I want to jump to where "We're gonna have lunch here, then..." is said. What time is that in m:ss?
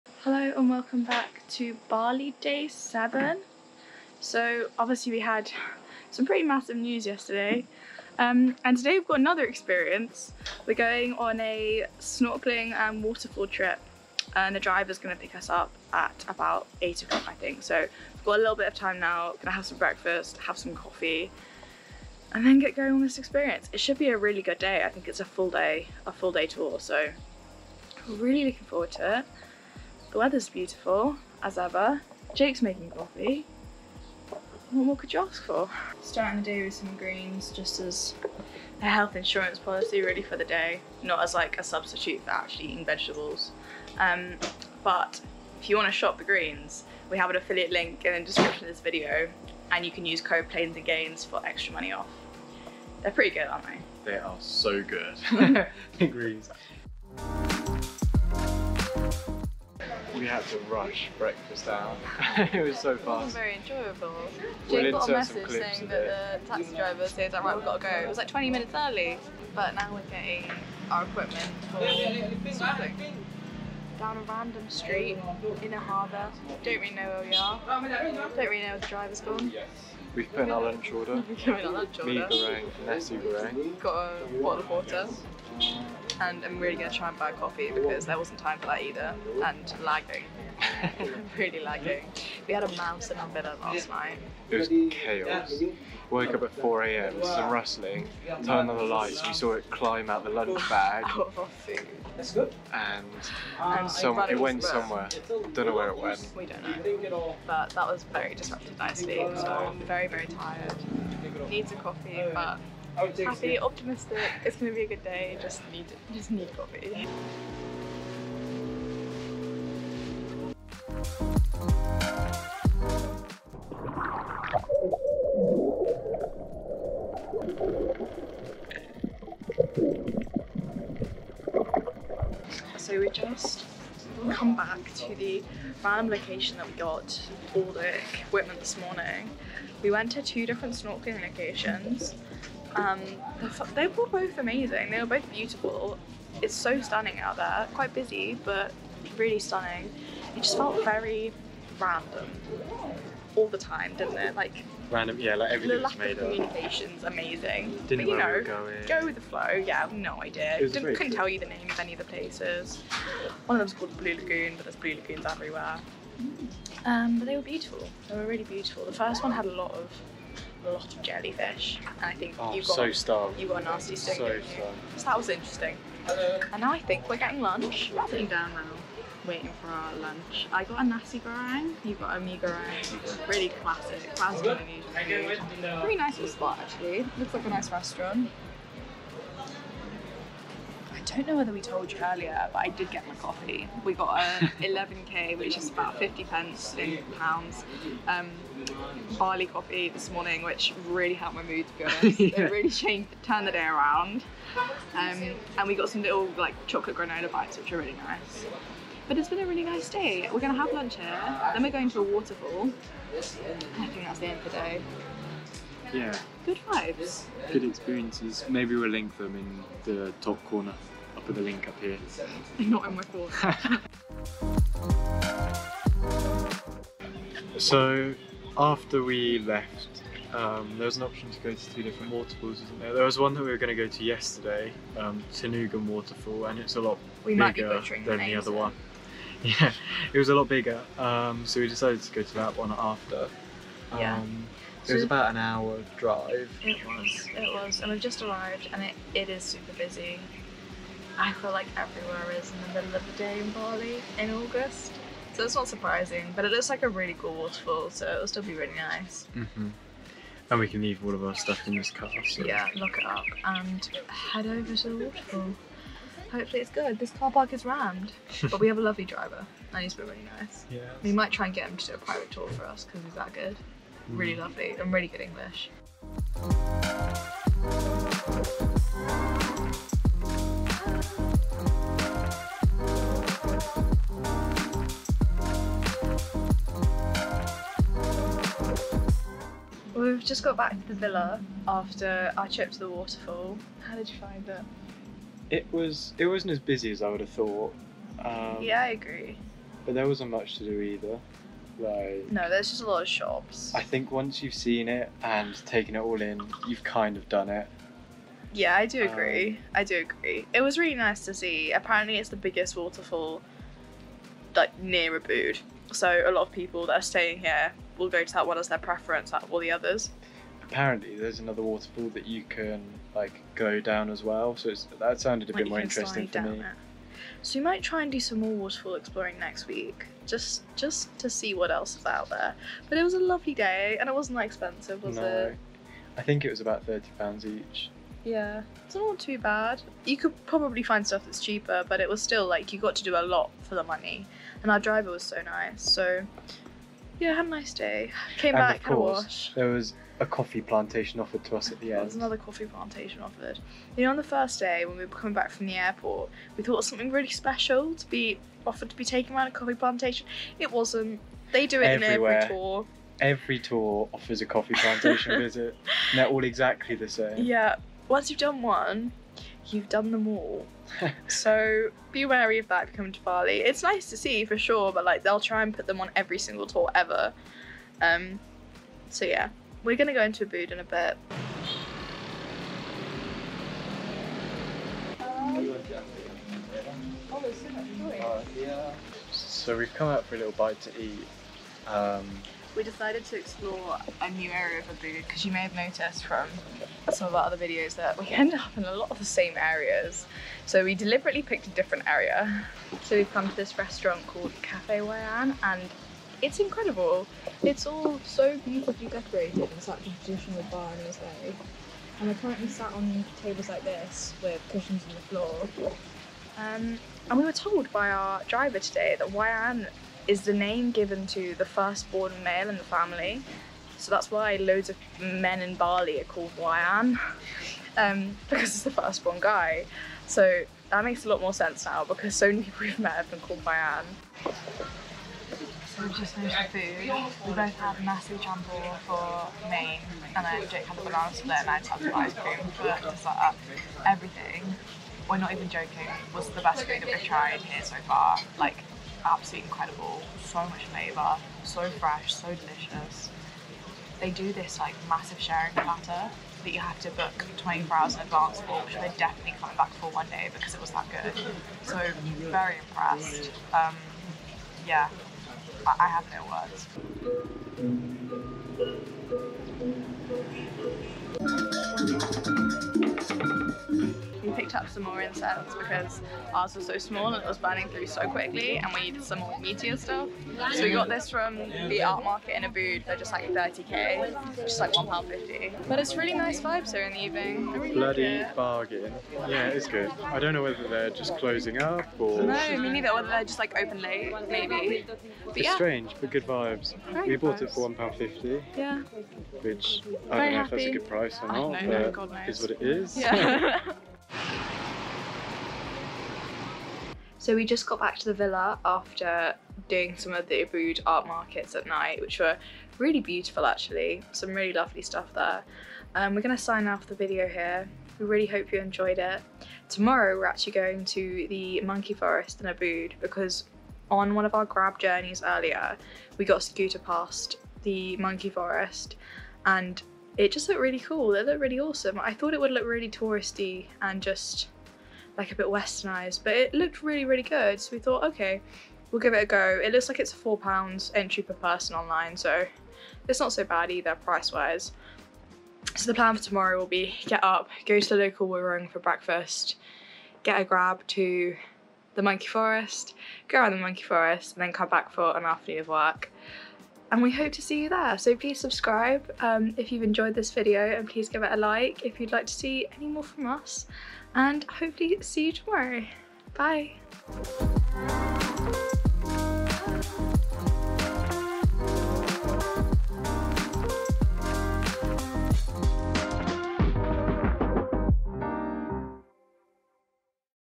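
3:30.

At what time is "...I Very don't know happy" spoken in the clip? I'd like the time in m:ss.
8:20.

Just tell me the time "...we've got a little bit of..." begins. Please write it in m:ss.
0:17.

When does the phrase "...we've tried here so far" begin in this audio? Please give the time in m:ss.
7:27.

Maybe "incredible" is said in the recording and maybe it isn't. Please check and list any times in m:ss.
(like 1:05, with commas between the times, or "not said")
6:46, 7:29.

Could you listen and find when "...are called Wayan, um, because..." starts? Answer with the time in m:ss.
7:06.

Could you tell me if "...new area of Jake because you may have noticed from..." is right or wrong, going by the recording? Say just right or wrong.
wrong.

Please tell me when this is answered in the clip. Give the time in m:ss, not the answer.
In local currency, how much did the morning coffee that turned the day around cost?
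3:14.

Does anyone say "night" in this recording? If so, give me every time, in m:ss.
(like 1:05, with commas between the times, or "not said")
1:33, 8:31.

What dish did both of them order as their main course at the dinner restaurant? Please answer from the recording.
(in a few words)
Nasi campur.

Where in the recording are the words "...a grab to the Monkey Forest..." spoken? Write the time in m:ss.
9:10.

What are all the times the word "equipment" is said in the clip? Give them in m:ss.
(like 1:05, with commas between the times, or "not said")
1:11, 2:18.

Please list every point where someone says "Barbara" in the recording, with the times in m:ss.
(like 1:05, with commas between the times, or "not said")
not said.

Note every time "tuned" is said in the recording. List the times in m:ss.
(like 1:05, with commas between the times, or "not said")
not said.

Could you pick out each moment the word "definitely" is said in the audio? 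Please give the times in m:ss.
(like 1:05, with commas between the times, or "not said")
7:39.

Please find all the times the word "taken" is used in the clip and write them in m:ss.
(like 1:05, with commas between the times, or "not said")
5:05, 5:59.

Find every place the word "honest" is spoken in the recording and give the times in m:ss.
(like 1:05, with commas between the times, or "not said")
3:21.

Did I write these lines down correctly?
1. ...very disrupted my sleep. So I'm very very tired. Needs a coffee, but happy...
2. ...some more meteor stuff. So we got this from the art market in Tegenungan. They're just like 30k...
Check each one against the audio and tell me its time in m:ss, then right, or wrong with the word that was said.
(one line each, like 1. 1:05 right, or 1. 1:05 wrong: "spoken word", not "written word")
1. 1:48 right
2. 7:59 wrong: "Ubud", not "Tegenungan".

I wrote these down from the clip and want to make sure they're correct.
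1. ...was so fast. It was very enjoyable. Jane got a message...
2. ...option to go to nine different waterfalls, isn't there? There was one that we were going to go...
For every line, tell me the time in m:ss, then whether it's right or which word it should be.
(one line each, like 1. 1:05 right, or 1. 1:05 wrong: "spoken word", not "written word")
1. 1:02 right
2. 3:51 wrong: "two", not "nine".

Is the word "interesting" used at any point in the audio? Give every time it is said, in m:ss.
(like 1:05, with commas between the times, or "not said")
2:55, 5:25.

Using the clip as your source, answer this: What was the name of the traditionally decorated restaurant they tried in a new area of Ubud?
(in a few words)
Cafe Wayan.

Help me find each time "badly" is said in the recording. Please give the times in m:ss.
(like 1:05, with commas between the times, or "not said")
not said.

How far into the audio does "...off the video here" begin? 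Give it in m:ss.
8:36.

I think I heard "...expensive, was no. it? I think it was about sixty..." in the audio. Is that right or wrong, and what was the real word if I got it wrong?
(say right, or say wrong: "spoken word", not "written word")
wrong: "thirty", not "sixty".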